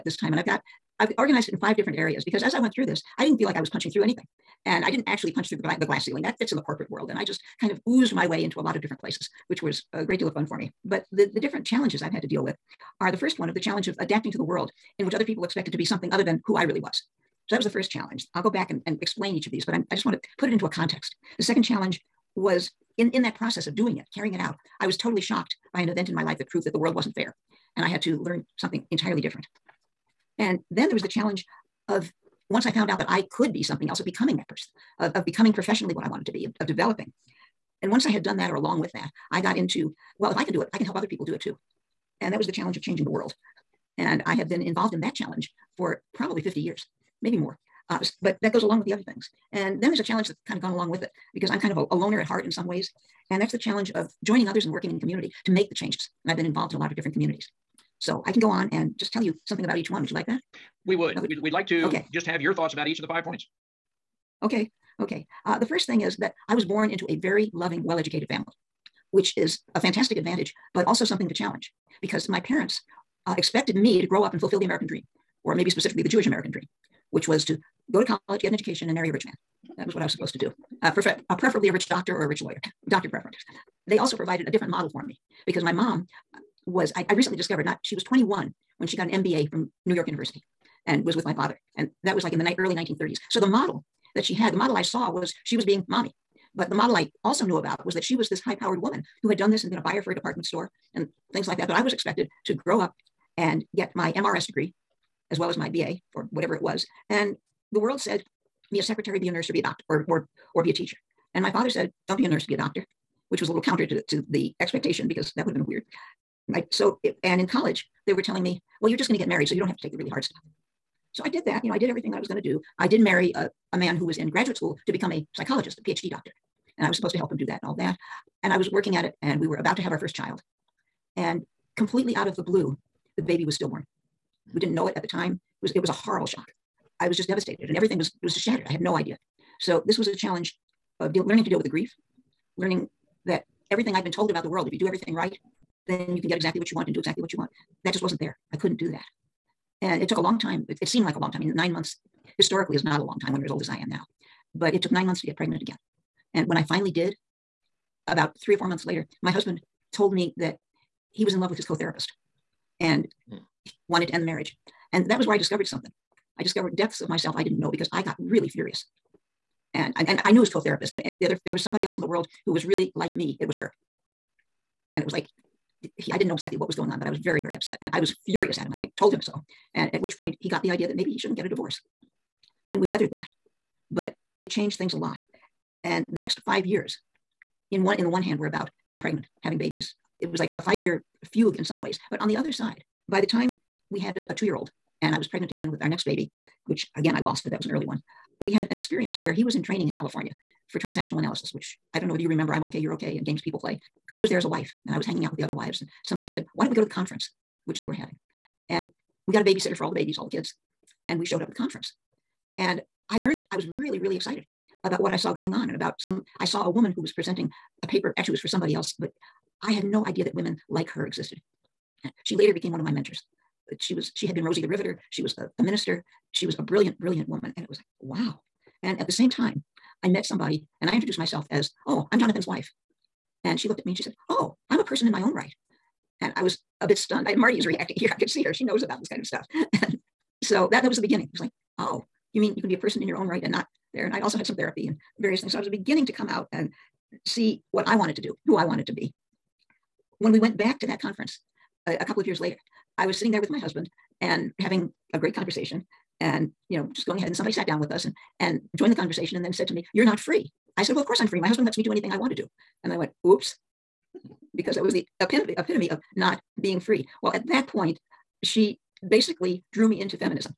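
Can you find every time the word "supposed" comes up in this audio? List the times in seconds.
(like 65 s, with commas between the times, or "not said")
80 s, 126 s.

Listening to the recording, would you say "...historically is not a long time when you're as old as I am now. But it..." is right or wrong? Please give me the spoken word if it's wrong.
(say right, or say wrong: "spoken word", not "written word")
right.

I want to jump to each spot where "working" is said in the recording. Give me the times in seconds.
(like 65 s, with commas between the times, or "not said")
54 s, 128 s.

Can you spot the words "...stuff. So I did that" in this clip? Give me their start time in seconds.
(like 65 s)
120 s.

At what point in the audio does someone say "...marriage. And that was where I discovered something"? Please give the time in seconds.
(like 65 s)
164 s.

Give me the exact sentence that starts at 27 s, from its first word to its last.
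And I had to learn something entirely different.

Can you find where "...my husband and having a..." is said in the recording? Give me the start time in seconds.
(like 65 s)
253 s.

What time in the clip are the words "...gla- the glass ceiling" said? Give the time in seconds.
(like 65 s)
5 s.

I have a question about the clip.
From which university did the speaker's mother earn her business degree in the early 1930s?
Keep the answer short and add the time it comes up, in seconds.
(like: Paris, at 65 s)
New York University, at 89 s.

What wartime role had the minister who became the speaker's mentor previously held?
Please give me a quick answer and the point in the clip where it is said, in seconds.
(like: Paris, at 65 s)
Rosie the Riveter, at 224 s.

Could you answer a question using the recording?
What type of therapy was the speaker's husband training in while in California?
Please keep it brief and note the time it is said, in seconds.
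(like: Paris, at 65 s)
transactional analysis, at 200 s.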